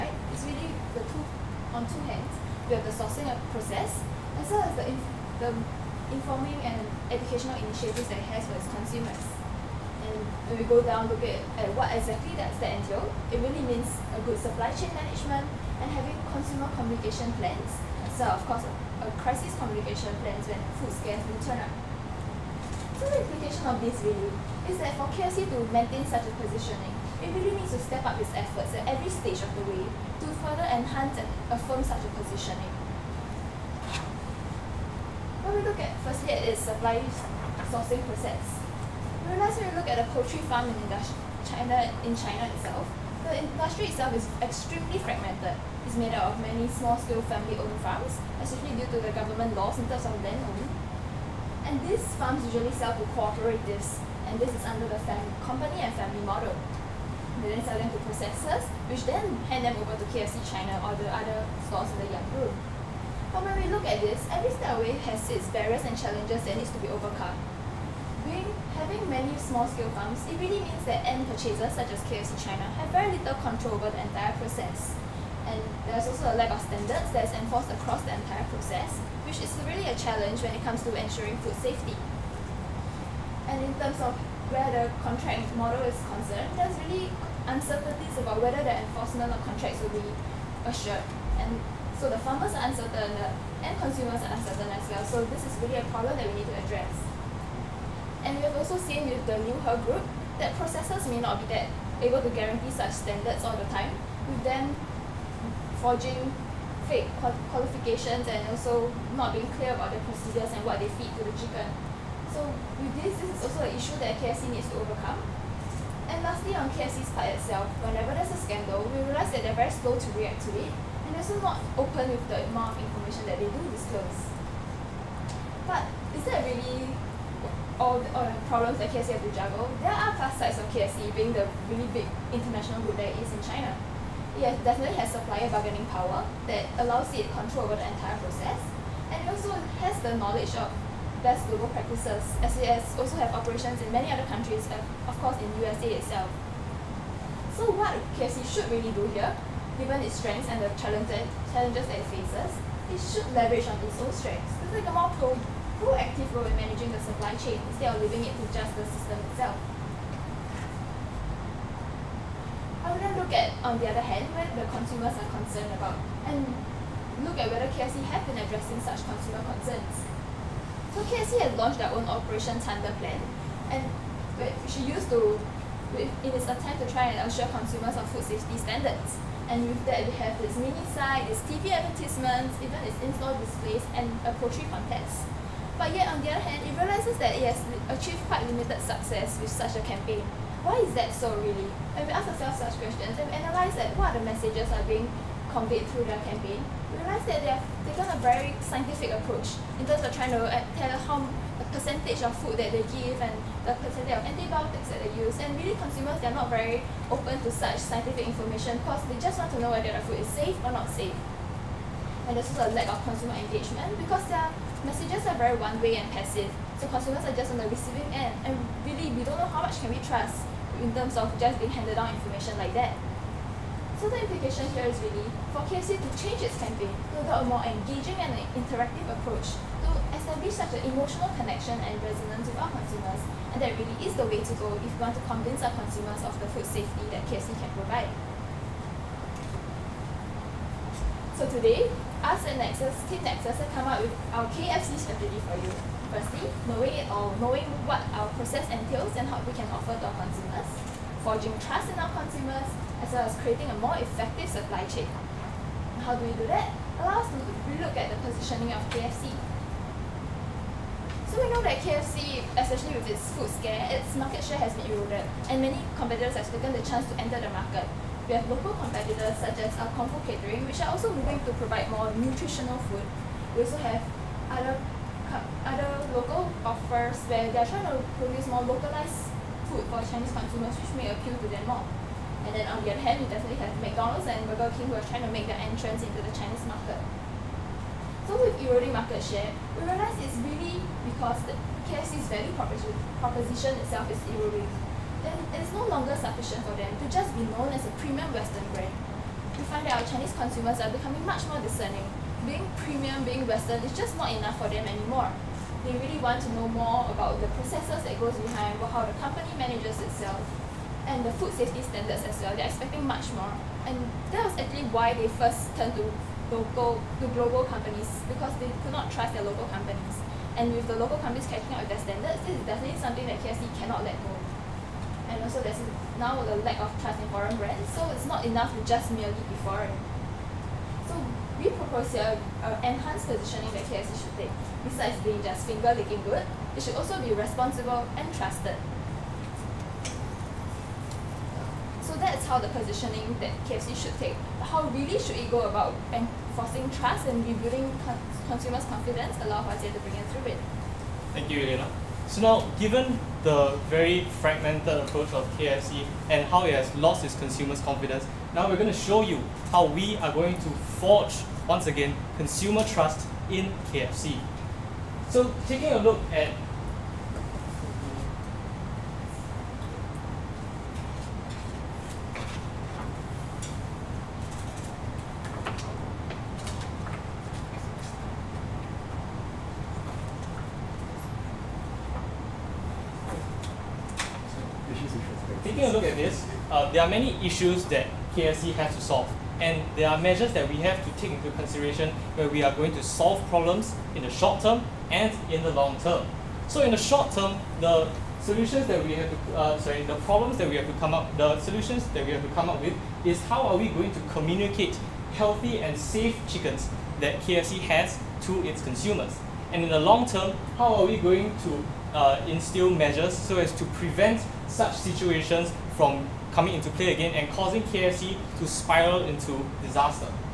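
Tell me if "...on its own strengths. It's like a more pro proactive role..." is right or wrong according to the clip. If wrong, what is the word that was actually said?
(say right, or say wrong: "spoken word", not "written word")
right.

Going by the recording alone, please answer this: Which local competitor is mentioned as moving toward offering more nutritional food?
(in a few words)
Comfort Catering.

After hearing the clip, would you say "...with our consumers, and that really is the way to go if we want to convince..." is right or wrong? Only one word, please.
right.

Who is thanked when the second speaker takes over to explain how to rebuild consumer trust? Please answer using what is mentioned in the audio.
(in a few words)
Elena.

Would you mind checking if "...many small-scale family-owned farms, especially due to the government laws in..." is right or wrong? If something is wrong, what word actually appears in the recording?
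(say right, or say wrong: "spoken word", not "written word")
right.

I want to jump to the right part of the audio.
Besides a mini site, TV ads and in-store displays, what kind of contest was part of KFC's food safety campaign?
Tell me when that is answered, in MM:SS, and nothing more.
03:04.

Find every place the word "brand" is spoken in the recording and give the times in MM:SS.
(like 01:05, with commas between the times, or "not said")
04:58, 05:27.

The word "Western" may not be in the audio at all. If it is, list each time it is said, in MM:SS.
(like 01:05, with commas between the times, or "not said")
04:58, 05:03.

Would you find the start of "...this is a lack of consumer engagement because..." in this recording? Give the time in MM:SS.
03:32.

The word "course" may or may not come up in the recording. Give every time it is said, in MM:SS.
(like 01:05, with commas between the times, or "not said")
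00:18, 02:25.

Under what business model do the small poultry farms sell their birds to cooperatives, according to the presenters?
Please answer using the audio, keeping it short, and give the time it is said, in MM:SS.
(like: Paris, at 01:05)
company and family model, at 00:55.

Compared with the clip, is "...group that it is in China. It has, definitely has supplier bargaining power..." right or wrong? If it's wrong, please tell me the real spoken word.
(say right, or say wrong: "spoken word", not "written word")
right.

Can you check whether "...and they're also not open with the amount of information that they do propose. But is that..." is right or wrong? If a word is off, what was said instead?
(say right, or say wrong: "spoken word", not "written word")
wrong: "disclose", not "propose".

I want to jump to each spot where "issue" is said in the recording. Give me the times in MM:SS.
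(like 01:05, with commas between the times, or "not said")
01:53, 06:27.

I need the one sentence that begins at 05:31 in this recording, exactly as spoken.
So we propose here uh, enhanced positioning that KFC should take.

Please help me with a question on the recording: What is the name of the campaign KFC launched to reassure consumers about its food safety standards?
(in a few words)
Operation Thunder.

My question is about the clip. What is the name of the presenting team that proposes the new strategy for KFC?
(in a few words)
Team Nexus.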